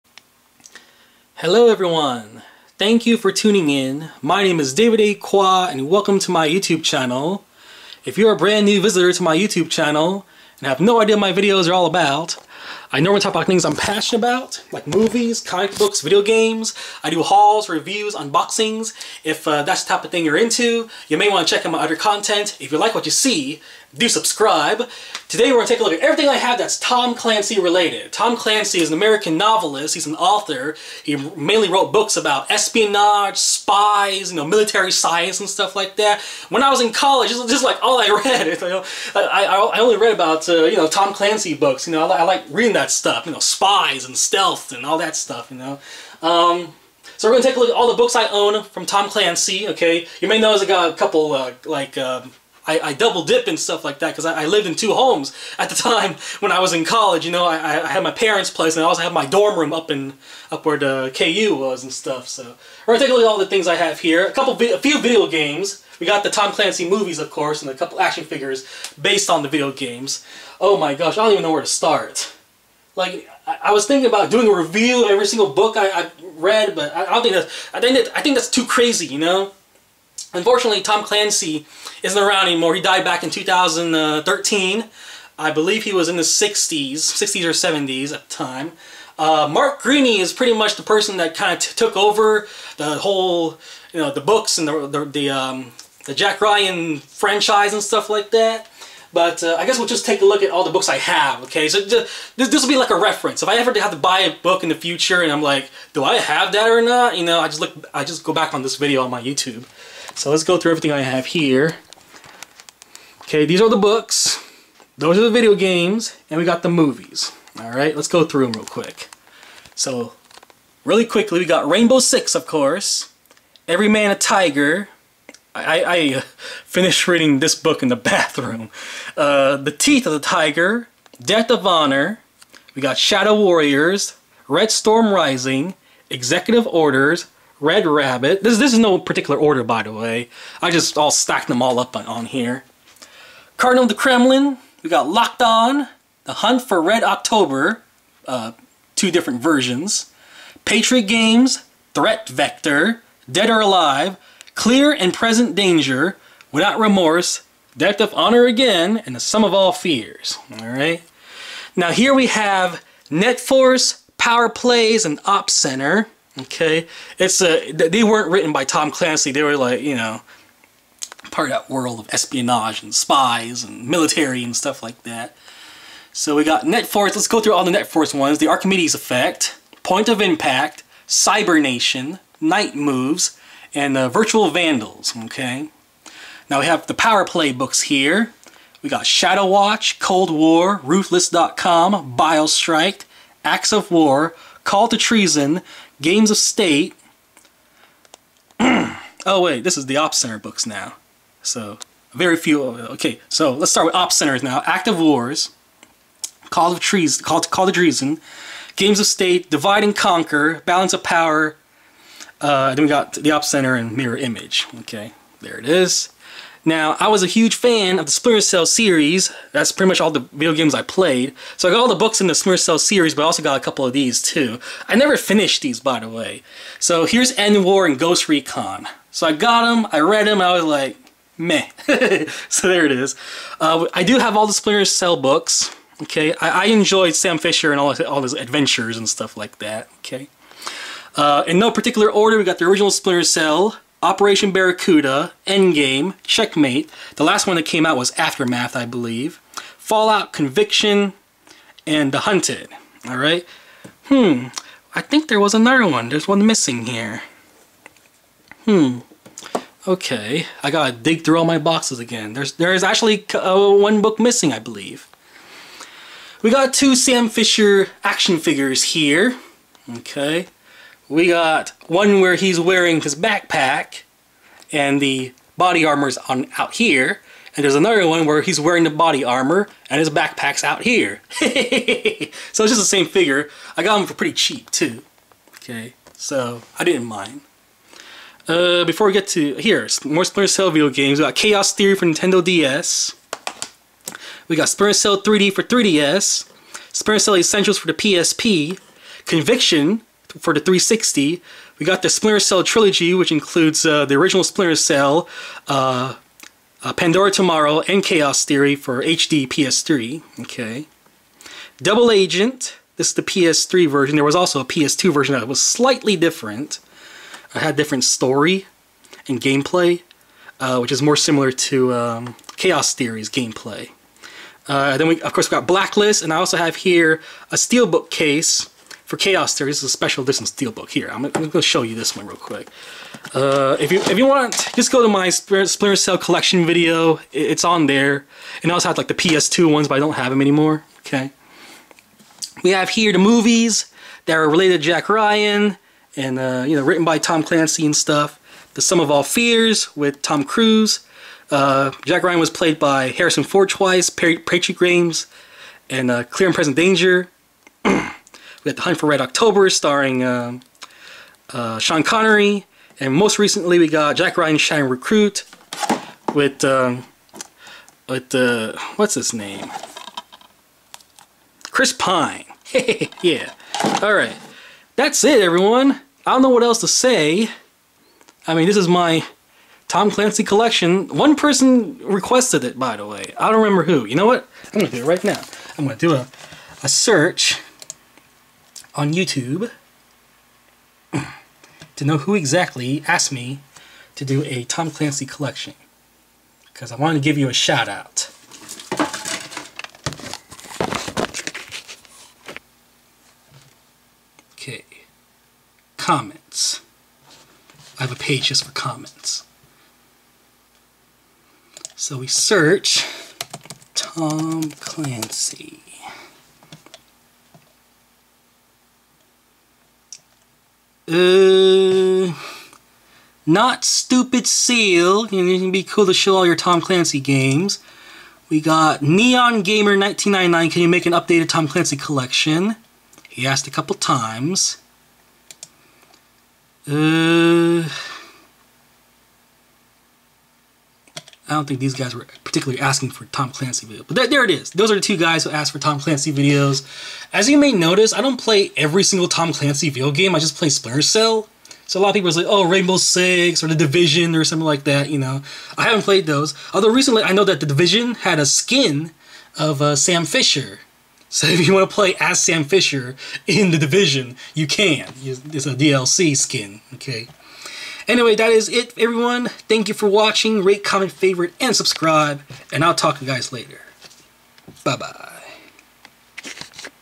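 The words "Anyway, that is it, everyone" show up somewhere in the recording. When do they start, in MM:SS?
07:48.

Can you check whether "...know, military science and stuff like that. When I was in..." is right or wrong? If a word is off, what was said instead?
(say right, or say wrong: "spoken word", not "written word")
right.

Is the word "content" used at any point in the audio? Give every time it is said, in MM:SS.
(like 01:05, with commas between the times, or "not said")
00:21.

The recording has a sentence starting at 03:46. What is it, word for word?
So here's End War and Ghost Recon.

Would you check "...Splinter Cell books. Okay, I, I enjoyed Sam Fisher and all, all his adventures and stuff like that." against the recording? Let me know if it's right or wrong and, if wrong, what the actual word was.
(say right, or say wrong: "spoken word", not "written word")
right.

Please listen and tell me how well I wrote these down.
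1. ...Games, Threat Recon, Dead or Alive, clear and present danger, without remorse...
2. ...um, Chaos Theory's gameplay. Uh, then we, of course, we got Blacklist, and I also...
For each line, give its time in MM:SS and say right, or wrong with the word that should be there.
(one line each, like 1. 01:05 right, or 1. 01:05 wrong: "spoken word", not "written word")
1. 02:31 wrong: "Vector", not "Recon"
2. 05:21 right.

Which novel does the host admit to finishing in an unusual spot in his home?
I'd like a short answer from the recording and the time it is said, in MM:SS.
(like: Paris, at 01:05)
Every Man a Tiger, at 02:03.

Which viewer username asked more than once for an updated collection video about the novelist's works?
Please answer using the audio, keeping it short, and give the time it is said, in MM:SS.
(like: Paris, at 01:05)
Neon Gamer 1999, at 07:09.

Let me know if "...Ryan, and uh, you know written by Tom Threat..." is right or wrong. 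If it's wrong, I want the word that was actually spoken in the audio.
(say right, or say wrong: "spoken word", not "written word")
wrong: "Clancy", not "Threat".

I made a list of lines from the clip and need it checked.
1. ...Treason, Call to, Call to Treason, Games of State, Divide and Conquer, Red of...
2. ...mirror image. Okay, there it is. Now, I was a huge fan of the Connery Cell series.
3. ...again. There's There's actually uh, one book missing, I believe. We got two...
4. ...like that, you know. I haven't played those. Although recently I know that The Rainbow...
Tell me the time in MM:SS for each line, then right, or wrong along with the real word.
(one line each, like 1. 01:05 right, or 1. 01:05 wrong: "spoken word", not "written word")
1. 03:26 wrong: "Balance", not "Red"
2. 03:33 wrong: "Splinter", not "Connery"
3. 04:21 right
4. 07:34 wrong: "Division", not "Rainbow".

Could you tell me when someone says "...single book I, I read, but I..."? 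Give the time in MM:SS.
01:15.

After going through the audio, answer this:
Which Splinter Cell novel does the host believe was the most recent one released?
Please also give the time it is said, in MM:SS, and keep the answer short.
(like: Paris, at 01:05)
Aftermath, at 04:08.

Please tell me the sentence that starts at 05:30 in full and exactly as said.
Here, I'm, I'm going to show you this one real quick.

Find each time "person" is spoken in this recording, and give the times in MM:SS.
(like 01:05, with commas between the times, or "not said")
01:30, 06:21.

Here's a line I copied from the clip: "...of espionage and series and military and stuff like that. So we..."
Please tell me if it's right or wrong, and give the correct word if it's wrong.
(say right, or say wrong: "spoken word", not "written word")
wrong: "spies", not "series".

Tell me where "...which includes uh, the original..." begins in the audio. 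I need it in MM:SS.
05:03.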